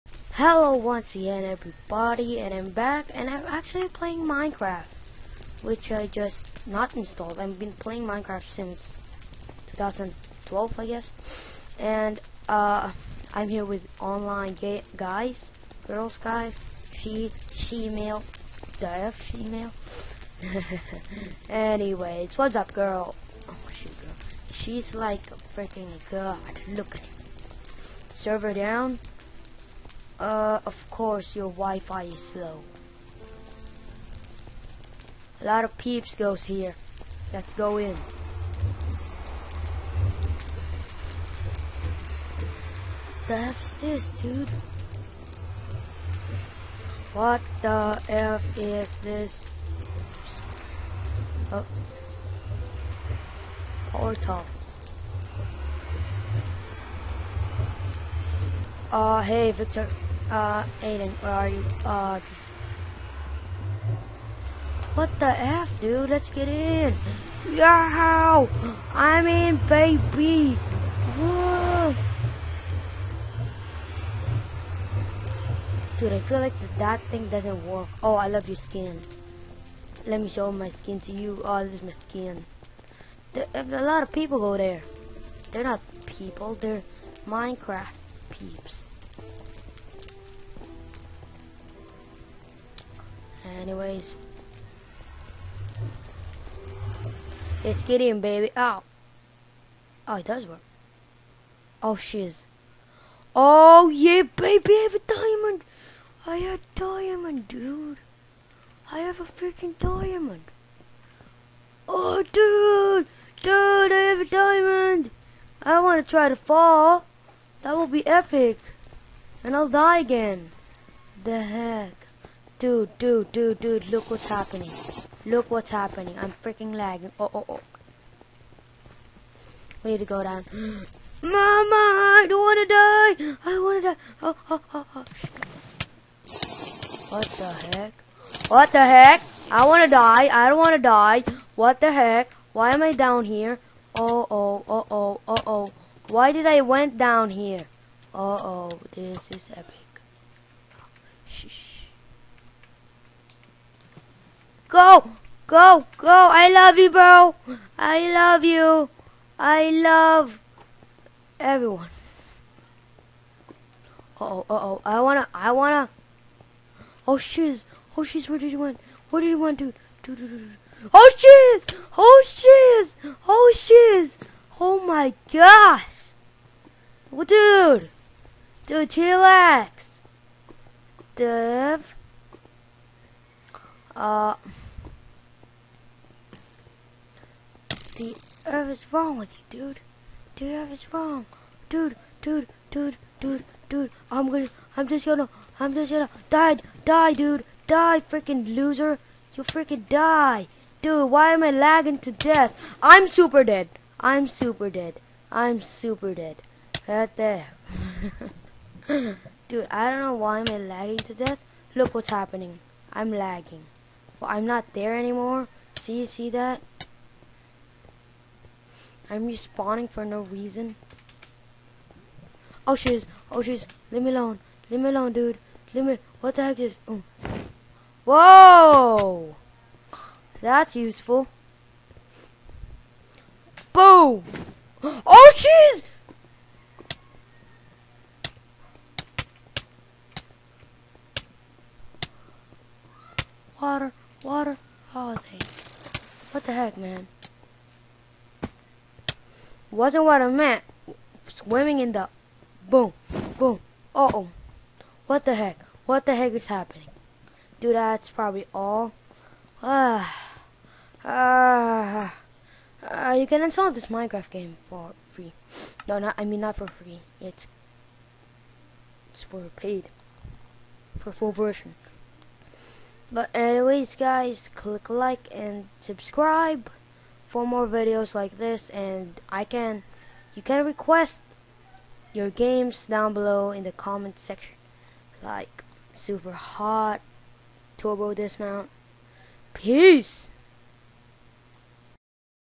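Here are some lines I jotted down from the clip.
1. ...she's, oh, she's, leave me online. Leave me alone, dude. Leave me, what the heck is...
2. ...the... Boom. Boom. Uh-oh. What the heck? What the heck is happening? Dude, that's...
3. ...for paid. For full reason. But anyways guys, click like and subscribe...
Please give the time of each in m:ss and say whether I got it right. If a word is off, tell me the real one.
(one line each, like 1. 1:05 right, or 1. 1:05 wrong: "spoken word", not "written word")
1. 3:42 wrong: "alone", not "online"
2. 4:11 right
3. 4:29 wrong: "version", not "reason".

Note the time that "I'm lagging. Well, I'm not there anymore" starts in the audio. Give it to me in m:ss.
3:32.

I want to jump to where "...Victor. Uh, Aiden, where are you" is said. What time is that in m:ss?
0:59.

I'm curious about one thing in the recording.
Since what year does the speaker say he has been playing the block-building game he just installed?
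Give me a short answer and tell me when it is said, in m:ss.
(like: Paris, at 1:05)
2012, at 0:09.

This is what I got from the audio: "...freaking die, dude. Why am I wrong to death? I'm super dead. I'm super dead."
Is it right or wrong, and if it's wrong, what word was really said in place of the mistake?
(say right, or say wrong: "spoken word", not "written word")
wrong: "lagging", not "wrong".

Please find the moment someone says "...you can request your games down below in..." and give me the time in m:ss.
4:40.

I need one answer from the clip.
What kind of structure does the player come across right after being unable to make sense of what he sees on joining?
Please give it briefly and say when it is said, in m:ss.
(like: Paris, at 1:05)
Portal, at 0:53.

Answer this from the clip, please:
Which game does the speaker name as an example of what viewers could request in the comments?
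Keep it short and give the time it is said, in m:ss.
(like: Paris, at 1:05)
Turbo Dismount, at 4:47.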